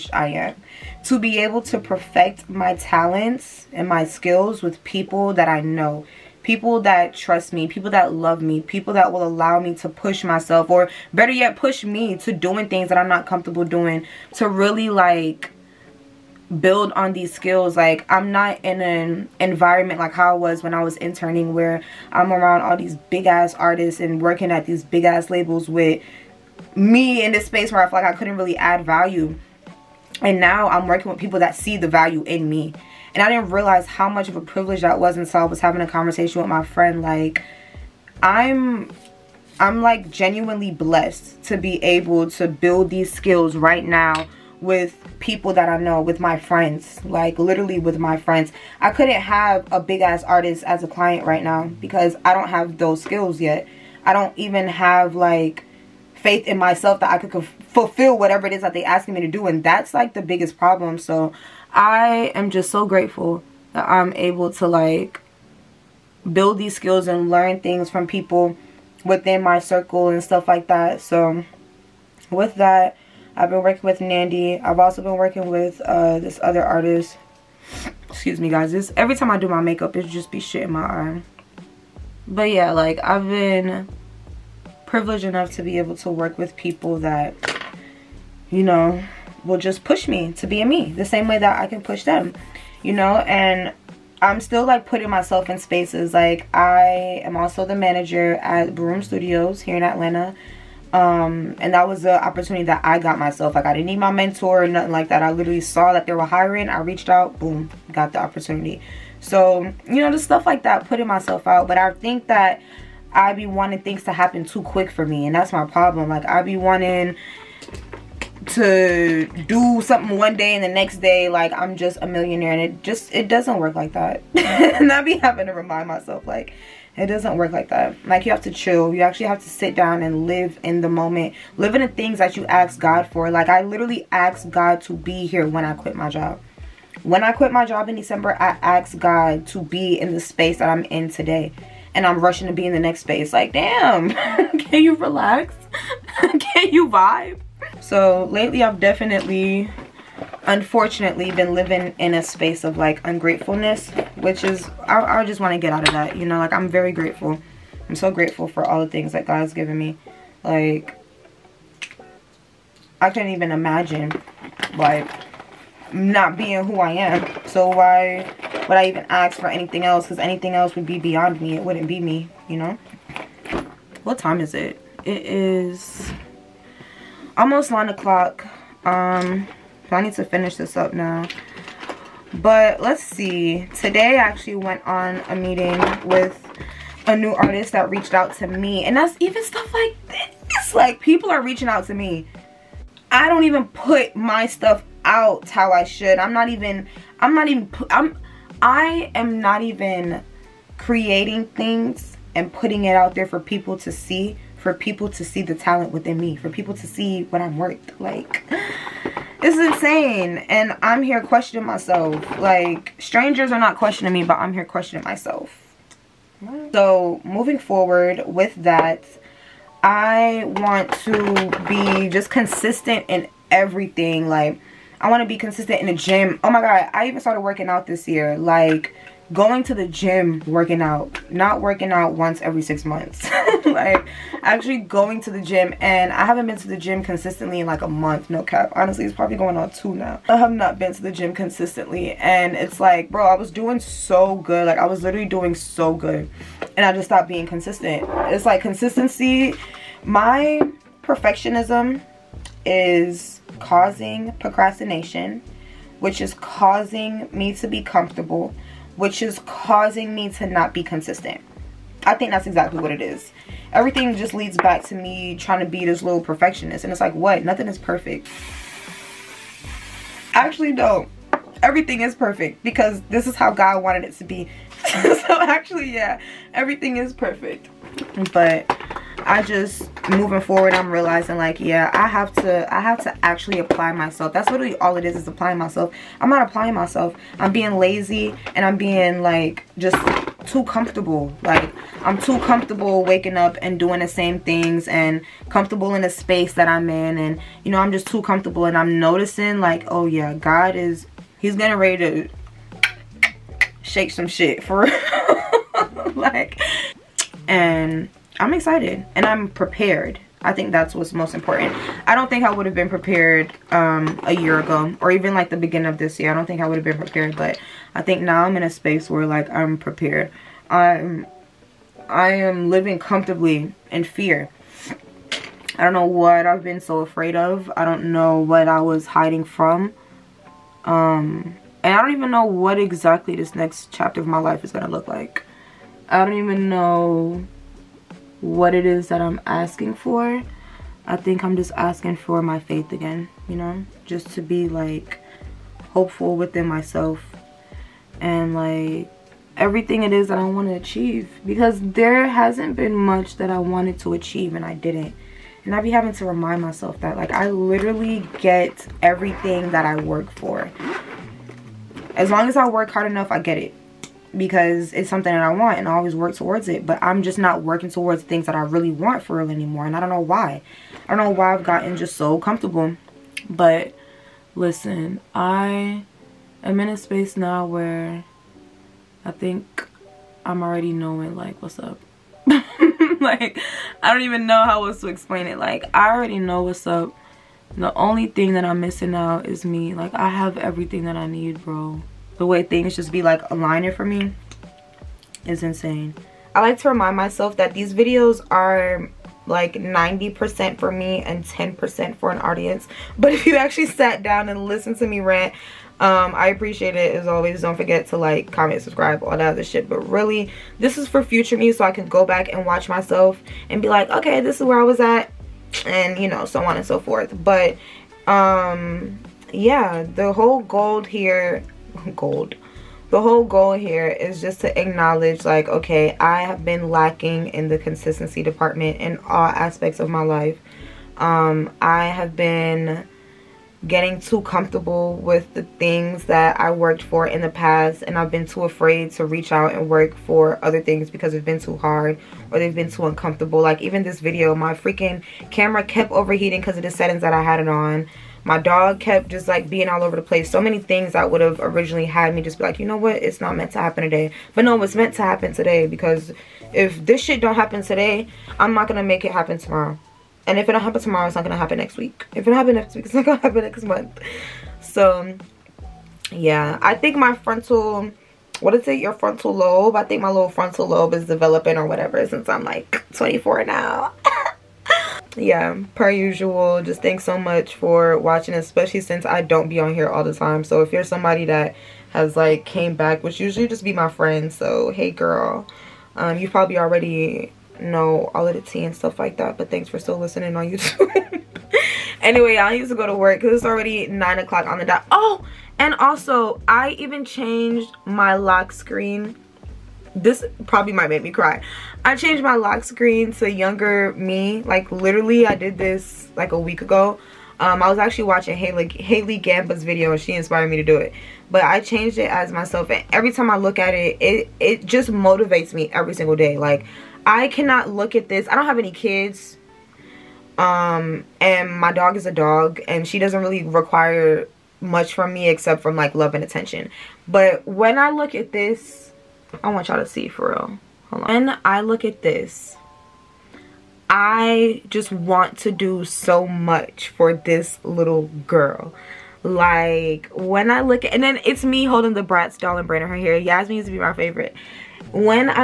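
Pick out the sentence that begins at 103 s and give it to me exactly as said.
Like I didn't need my mentor or nothing like that.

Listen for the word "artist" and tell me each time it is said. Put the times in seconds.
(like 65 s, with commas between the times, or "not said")
23 s, 50 s, 76 s, 187 s.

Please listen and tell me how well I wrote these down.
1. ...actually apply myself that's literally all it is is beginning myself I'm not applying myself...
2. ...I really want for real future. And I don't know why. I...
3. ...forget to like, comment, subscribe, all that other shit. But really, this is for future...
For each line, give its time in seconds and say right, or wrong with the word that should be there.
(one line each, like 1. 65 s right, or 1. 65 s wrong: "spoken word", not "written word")
1. 283 s wrong: "applying", not "beginning"
2. 368 s wrong: "anymore", not "future"
3. 407 s right.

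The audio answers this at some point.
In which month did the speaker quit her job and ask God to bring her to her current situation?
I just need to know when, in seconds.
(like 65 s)
137 s.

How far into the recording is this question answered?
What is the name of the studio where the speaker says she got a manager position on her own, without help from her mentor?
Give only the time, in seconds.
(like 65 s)
98 s.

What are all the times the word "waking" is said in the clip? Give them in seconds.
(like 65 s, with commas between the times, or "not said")
293 s.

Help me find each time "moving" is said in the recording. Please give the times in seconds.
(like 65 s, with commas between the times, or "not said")
217 s, 280 s.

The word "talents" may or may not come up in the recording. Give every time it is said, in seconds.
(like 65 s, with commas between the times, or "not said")
2 s, 205 s.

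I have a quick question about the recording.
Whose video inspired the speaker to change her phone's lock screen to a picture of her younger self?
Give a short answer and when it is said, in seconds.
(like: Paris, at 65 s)
Haley Gamba, at 508 s.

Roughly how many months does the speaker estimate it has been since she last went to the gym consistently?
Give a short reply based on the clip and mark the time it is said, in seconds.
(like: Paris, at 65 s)
2, at 239 s.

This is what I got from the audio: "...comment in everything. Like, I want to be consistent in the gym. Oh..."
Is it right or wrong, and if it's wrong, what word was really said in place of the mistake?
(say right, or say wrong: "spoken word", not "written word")
wrong: "consistent", not "comment".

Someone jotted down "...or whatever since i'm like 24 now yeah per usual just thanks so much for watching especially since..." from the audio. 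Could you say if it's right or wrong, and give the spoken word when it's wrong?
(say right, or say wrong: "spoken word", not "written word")
right.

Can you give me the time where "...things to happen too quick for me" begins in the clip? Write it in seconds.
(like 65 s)
113 s.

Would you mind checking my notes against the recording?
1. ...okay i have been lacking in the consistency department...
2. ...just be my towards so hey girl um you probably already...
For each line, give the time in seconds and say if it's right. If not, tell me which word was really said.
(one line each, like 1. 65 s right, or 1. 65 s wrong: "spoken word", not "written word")
1. 425 s right
2. 483 s wrong: "friends", not "towards".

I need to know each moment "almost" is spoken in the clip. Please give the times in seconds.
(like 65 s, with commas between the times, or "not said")
177 s.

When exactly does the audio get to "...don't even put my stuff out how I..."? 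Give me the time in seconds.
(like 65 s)
193 s.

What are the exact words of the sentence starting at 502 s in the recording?
I changed my lock screen to younger me.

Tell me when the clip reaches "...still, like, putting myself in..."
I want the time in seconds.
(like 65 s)
94 s.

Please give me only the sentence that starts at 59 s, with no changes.
And that's like the biggest problem.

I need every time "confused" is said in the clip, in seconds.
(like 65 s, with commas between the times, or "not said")
not said.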